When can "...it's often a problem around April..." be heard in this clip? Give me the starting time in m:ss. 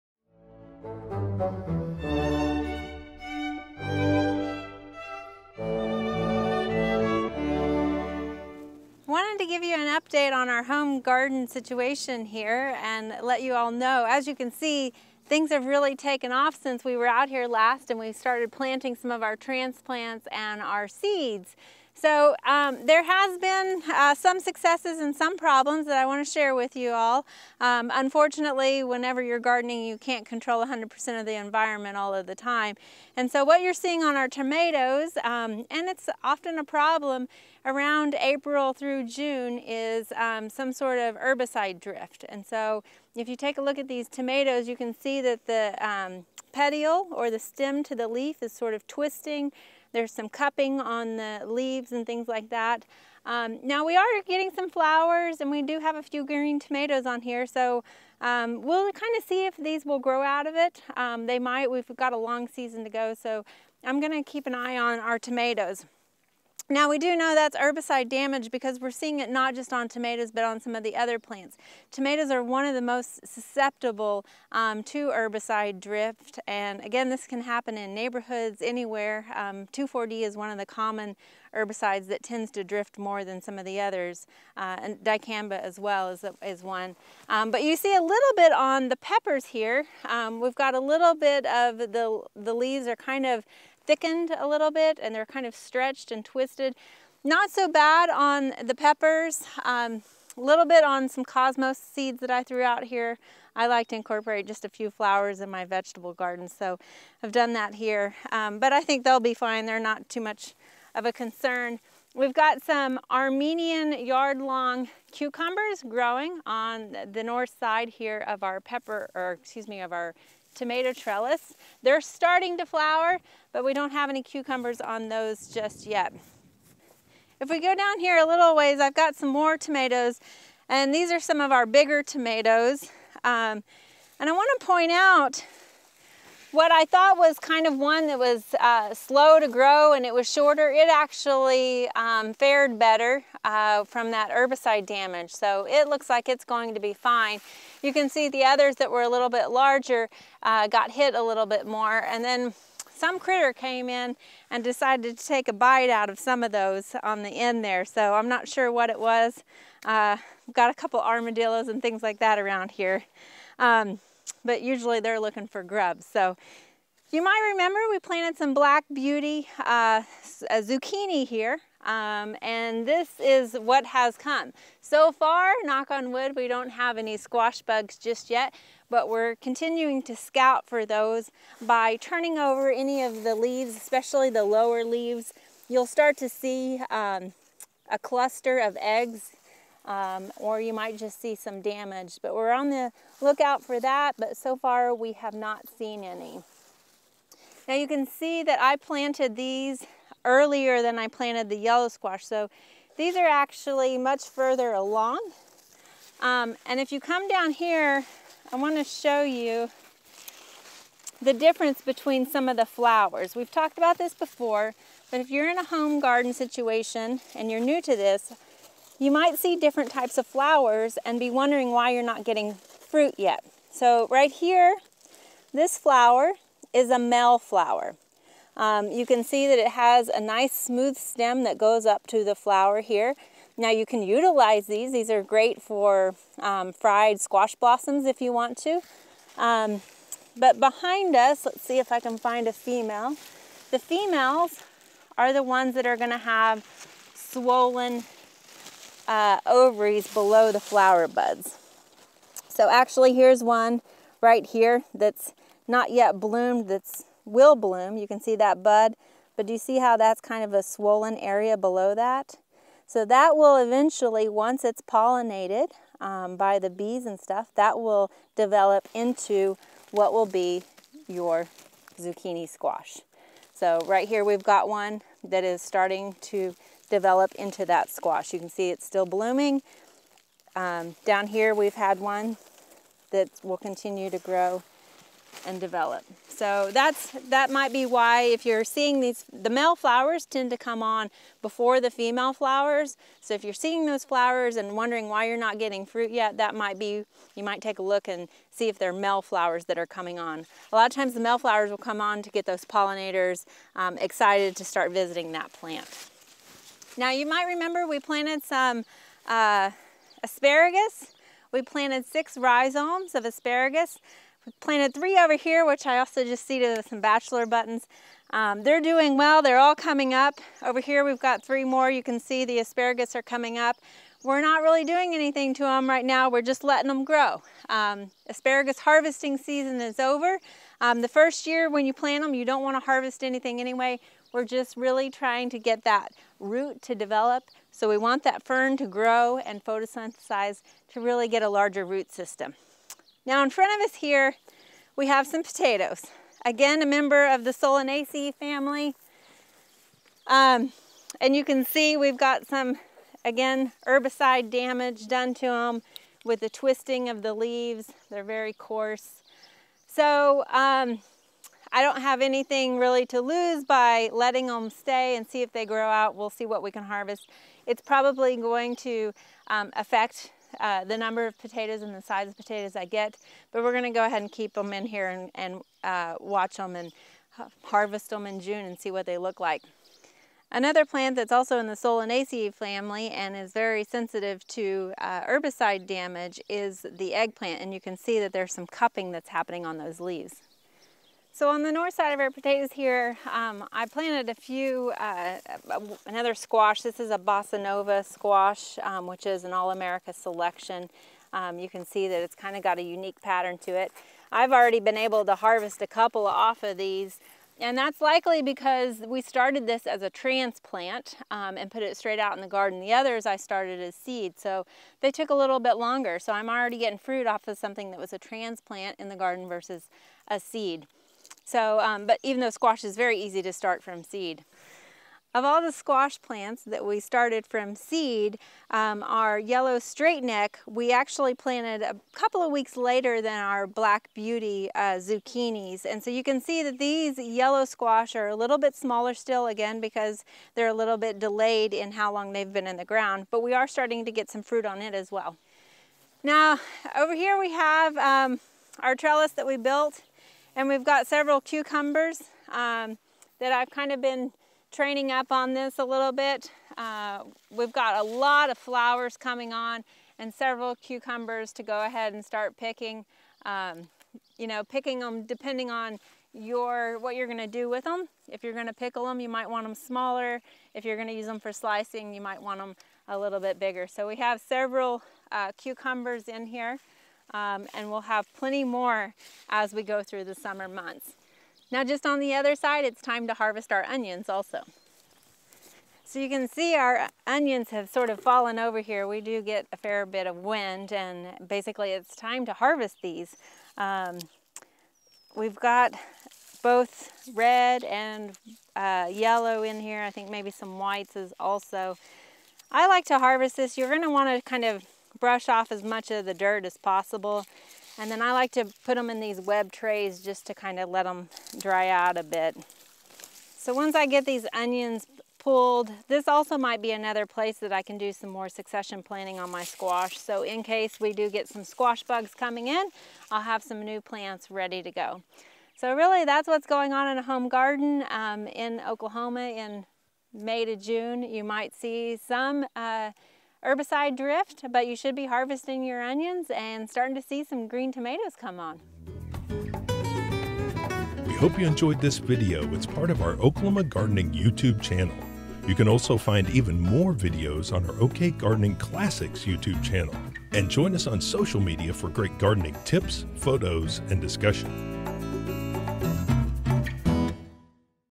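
0:35.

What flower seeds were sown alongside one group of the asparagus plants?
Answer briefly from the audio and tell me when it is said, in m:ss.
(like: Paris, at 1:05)
Bachelor buttons, at 5:16.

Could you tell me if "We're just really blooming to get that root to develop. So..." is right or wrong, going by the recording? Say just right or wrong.
wrong.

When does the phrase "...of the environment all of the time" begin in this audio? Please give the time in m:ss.
0:31.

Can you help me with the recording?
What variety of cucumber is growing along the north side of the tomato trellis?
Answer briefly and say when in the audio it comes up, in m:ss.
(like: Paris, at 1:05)
Armenian yard-long, at 1:53.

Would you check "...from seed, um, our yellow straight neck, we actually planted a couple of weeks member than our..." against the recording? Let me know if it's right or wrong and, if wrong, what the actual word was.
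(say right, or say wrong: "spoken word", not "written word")
wrong: "later", not "member".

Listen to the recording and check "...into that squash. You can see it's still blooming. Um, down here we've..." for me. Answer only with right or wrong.
right.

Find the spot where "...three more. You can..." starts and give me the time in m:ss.
5:21.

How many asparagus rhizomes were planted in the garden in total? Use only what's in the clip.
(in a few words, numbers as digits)
6.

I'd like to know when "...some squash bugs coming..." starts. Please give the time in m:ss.
8:41.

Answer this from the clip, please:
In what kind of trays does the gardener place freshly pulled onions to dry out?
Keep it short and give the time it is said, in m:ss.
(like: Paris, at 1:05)
Web trays, at 8:29.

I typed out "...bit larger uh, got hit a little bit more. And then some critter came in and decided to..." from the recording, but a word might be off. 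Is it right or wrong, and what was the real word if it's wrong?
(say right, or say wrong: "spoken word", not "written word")
right.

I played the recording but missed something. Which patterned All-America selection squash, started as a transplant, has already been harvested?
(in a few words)
Bossa Nova.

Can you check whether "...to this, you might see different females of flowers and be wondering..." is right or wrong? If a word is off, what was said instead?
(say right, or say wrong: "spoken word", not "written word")
wrong: "types", not "females".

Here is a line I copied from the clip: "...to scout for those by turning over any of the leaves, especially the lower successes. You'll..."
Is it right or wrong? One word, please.
wrong.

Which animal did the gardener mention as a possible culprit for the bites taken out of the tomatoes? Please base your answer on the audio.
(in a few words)
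Armadillos.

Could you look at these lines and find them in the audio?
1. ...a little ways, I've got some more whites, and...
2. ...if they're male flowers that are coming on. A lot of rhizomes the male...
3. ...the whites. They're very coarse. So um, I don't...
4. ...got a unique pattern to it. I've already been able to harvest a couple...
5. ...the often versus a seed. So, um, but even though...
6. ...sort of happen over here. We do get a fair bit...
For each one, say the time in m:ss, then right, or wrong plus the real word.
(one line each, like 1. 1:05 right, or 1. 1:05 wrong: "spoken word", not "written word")
1. 2:08 wrong: "tomatoes", not "whites"
2. 4:58 wrong: "times", not "rhizomes"
3. 5:57 wrong: "leaves", not "whites"
4. 6:42 right
5. 6:59 wrong: "garden", not "often"
6. 8:07 wrong: "fallen", not "happen".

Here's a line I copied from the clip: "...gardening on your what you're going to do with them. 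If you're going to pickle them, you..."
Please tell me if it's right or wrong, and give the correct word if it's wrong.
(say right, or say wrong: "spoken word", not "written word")
wrong: "depending", not "gardening".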